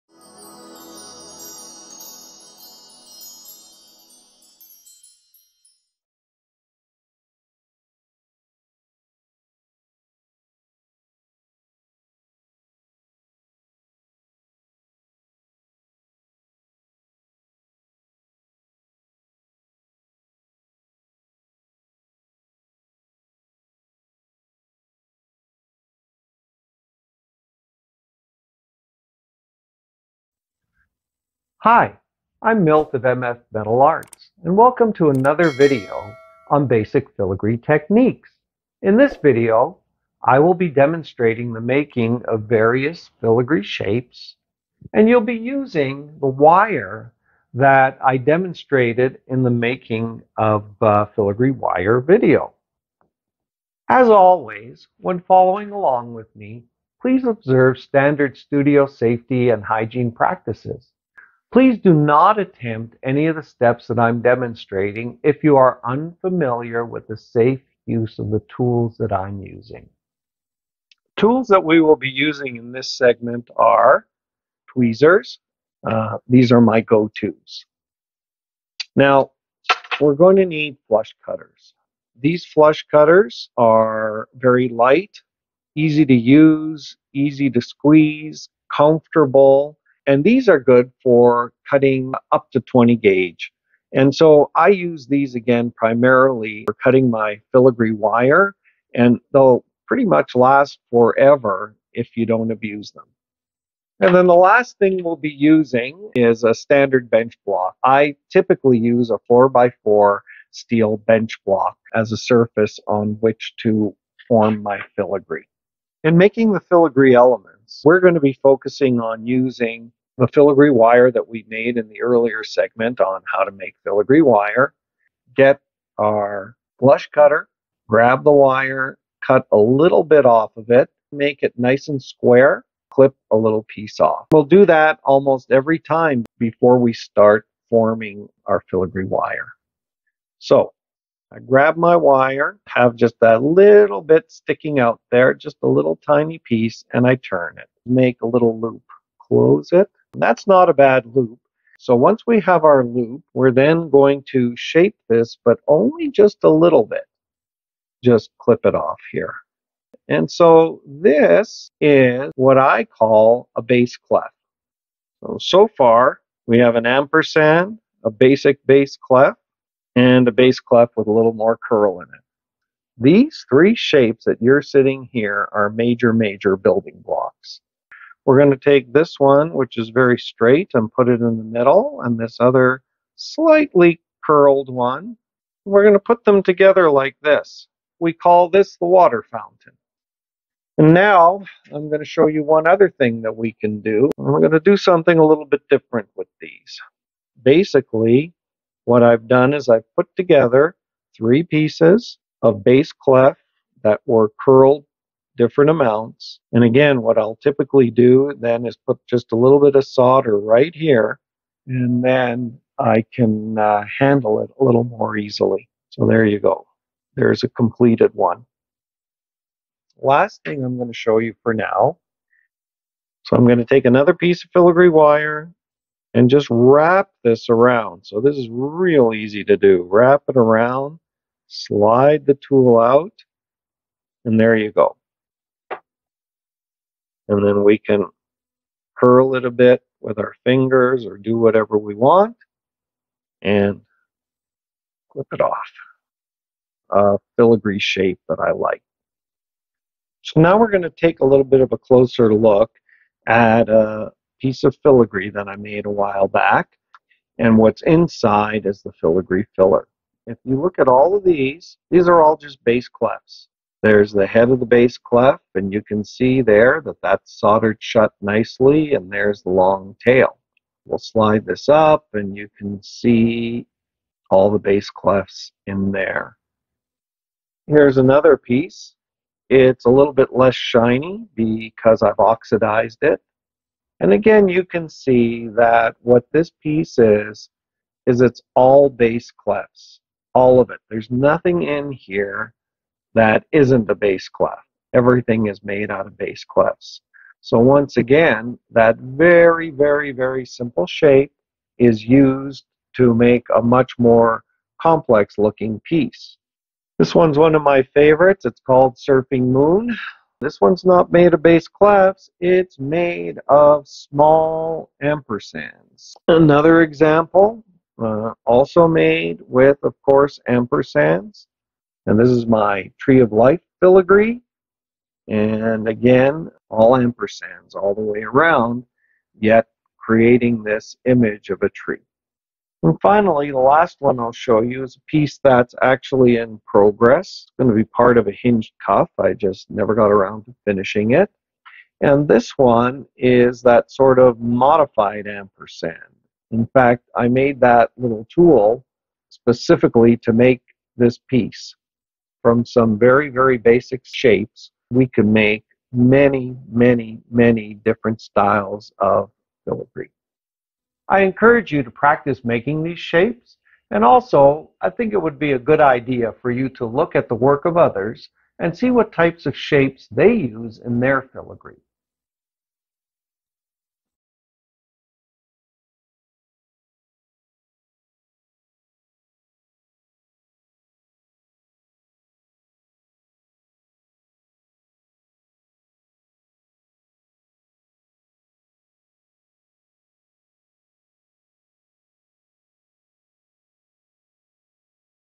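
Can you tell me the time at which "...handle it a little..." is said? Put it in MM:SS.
03:33.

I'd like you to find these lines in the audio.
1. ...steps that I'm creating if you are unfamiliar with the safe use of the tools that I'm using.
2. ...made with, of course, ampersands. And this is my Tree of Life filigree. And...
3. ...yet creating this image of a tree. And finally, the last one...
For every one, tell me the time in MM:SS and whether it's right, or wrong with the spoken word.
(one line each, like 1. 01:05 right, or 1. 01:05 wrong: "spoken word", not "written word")
1. 01:03 wrong: "demonstrating", not "creating"
2. 05:18 right
3. 05:29 right.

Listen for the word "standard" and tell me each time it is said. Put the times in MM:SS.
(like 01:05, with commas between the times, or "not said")
00:57, 01:46.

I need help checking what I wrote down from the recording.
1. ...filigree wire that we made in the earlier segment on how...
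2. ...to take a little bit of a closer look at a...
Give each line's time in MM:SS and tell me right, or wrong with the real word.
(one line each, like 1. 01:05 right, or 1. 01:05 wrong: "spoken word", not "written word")
1. 02:00 right
2. 04:10 right.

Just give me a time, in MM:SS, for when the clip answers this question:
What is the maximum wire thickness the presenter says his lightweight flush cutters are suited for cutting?
01:32.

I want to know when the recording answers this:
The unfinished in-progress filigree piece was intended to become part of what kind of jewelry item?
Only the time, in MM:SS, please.
05:38.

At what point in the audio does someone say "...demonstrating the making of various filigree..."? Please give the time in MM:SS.
00:40.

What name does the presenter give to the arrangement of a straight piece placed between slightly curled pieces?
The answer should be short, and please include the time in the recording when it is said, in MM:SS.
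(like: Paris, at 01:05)
water fountain, at 03:08.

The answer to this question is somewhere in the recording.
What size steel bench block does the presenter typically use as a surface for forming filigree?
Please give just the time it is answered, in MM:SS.
01:49.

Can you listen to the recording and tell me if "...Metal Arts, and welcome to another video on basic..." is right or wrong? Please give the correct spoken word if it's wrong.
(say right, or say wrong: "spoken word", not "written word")
right.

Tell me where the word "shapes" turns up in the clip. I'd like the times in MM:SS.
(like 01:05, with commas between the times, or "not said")
00:43, 02:34, 02:53, 04:07, 05:00, 05:54, 06:02, 06:09.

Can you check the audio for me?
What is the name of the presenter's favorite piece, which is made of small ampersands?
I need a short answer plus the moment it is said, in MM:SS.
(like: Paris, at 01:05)
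Surfing Moon, at 05:08.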